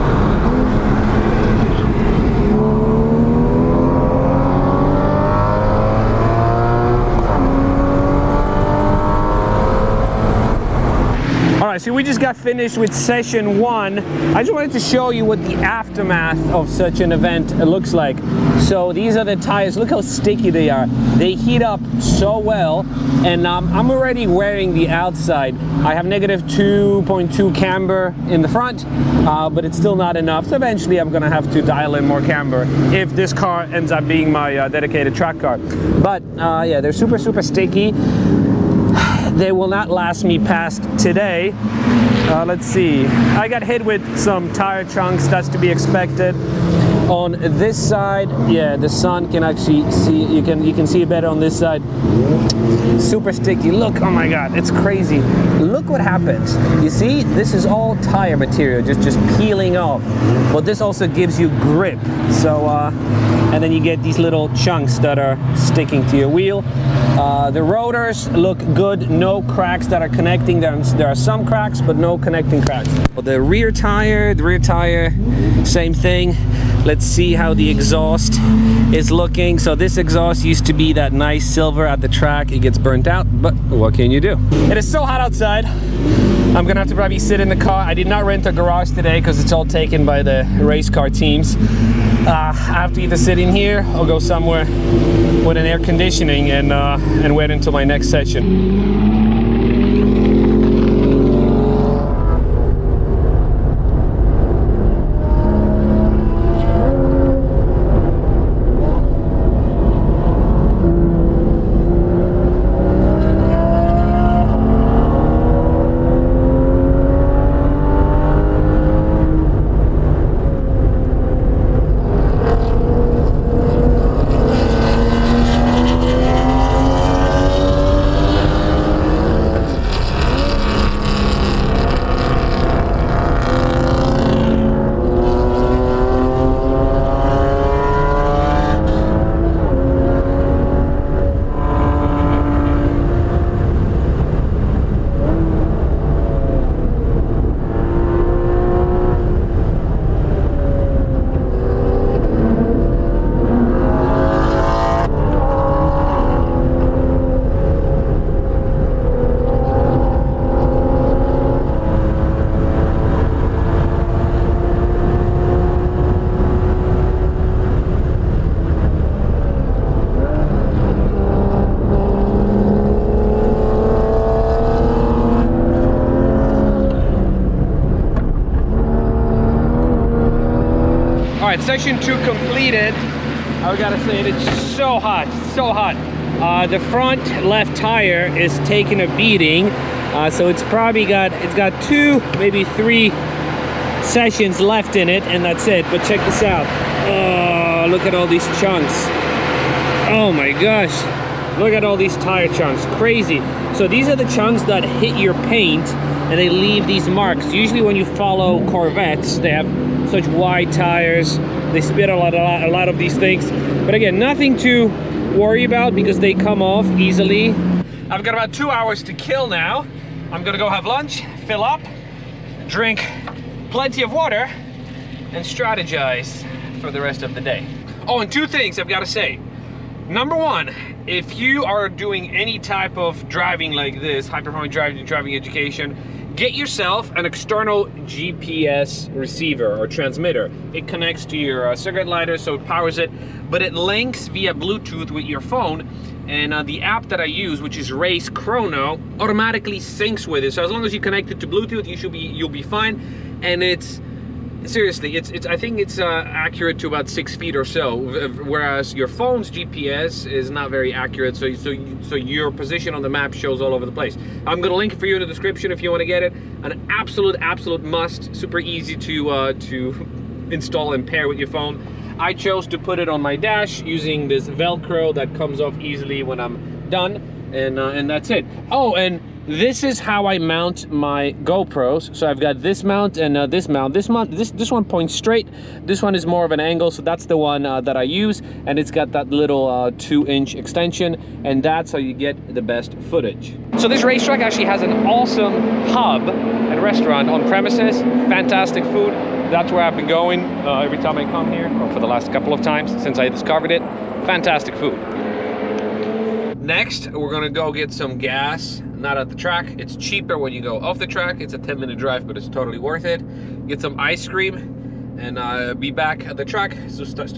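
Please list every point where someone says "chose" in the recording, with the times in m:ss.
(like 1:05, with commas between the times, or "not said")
4:32.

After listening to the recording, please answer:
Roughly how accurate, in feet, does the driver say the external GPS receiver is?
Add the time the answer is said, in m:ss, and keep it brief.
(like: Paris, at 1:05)
6 feet, at 4:17.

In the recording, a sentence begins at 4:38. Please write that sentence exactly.
Oh, and this is how I mount my GoPros.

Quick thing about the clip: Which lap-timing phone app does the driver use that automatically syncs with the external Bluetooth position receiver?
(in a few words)
RaceChrono.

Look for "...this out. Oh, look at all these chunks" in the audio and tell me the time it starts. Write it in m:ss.
3:16.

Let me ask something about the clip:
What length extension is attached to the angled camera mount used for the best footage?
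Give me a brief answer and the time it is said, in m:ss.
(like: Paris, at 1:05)
2-inch, at 4:49.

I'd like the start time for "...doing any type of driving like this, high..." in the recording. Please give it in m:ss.
3:51.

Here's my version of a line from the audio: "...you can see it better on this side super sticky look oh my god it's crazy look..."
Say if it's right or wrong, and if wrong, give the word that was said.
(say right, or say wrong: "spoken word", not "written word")
right.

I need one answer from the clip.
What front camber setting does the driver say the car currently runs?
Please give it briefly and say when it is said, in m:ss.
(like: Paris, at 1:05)
-2.2, at 0:26.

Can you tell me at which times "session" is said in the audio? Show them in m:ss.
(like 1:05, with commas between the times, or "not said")
0:12, 1:38, 3:14.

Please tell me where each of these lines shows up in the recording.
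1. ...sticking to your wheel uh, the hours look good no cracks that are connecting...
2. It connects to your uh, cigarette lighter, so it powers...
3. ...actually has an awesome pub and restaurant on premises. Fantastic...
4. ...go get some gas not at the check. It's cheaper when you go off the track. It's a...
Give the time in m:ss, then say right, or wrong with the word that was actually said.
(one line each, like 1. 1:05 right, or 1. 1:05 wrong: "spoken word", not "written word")
1. 1:05 wrong: "rotors", not "hours"
2. 4:00 right
3. 4:54 right
4. 5:07 wrong: "track", not "check".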